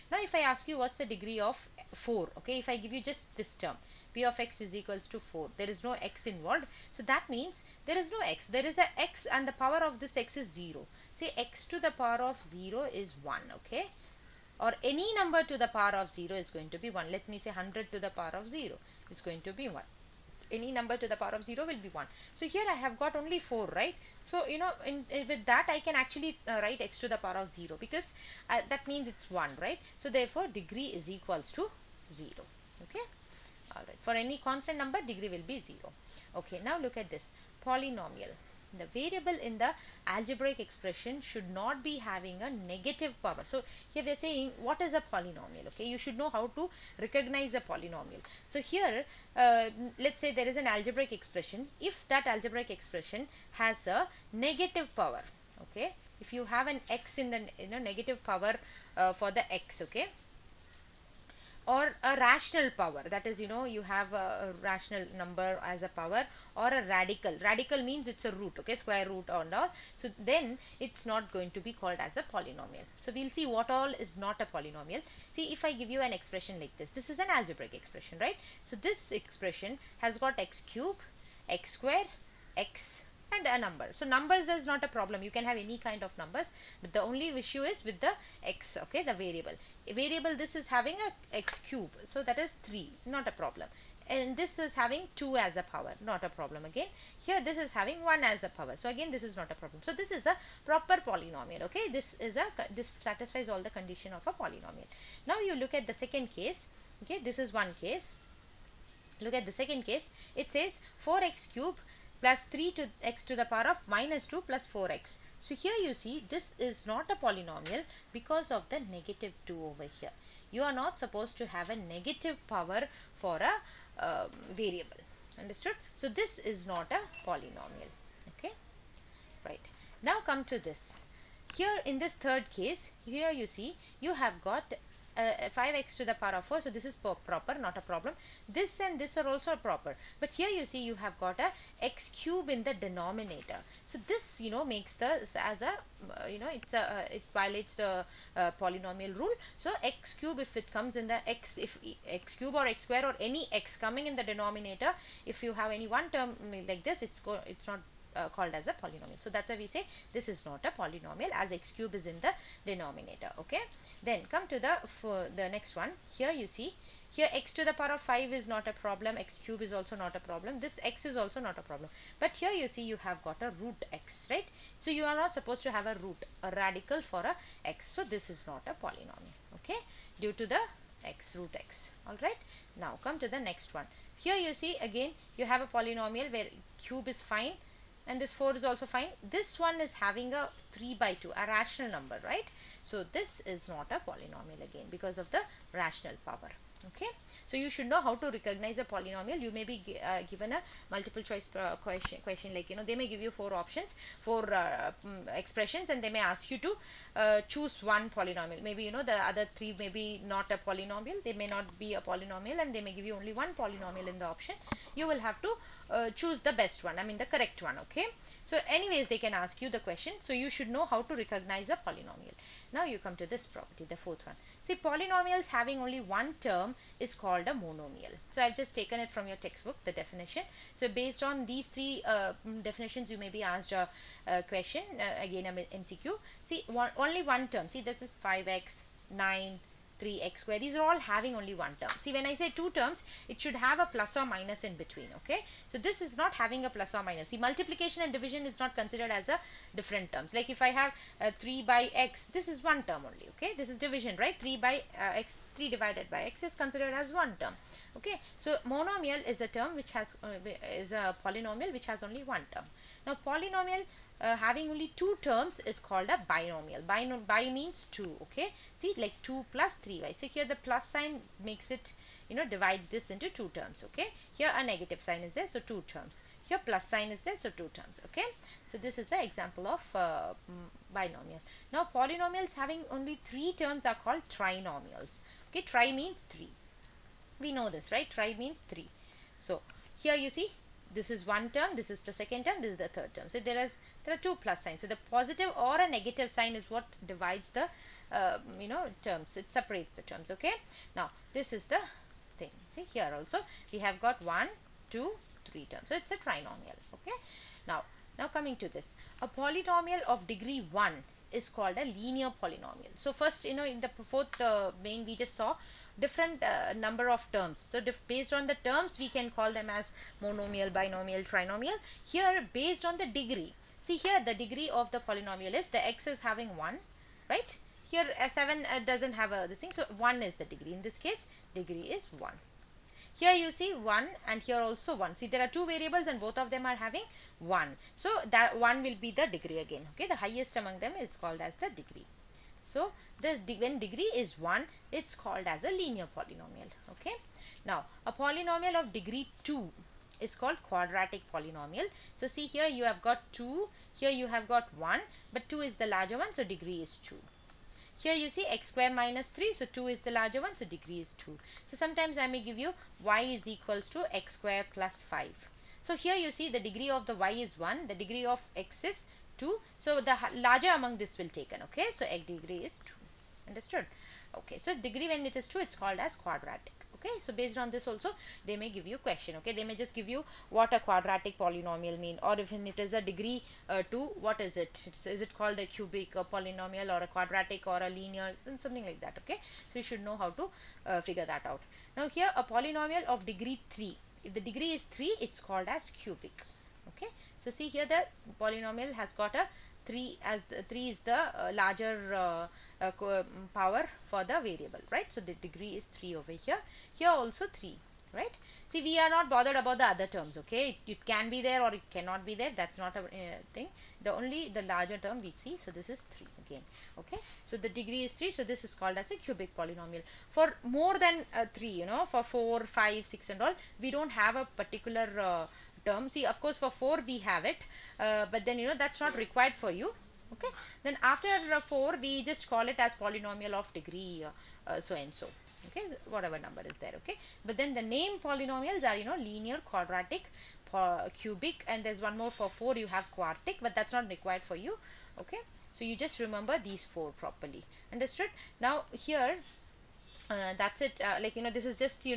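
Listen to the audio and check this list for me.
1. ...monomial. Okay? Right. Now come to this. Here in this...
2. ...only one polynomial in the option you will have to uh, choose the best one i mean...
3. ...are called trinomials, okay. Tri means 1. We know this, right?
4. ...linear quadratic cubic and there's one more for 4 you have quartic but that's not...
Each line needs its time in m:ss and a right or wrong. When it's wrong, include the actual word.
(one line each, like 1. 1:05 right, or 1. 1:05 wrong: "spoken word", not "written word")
1. 2:07 wrong: "polynomial", not "monomial"
2. 3:33 right
3. 4:43 wrong: "3", not "1"
4. 7:19 right.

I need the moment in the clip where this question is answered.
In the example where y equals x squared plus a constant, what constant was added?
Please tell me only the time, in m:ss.
6:04.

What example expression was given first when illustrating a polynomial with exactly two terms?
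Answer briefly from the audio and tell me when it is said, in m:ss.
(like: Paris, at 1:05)
2 + 3y, at 4:29.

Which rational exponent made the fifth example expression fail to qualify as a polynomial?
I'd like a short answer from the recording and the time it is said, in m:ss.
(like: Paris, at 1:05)
3/2, at 3:10.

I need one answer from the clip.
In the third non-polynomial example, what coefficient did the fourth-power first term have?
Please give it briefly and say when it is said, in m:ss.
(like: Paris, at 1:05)
5, at 2:15.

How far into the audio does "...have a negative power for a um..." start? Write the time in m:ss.
2:01.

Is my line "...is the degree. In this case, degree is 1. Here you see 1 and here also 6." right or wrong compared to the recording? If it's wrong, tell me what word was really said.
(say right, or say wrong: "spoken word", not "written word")
wrong: "1", not "6".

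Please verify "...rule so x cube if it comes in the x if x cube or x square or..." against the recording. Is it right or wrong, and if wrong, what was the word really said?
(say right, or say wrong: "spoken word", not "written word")
right.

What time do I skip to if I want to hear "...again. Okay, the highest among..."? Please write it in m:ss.
5:39.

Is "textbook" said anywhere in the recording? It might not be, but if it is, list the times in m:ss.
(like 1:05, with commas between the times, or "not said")
3:49.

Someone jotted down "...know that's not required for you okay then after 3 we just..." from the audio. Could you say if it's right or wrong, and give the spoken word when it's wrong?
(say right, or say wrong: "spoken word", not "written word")
wrong: "4", not "3".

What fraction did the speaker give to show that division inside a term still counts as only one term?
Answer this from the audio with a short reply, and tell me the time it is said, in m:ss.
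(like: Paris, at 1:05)
3/x, at 4:11.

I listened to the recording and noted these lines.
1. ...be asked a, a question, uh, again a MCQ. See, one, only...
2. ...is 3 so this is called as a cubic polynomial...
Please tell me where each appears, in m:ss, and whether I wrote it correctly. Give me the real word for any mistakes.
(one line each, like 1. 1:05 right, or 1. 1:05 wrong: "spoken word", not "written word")
1. 3:53 right
2. 6:58 right.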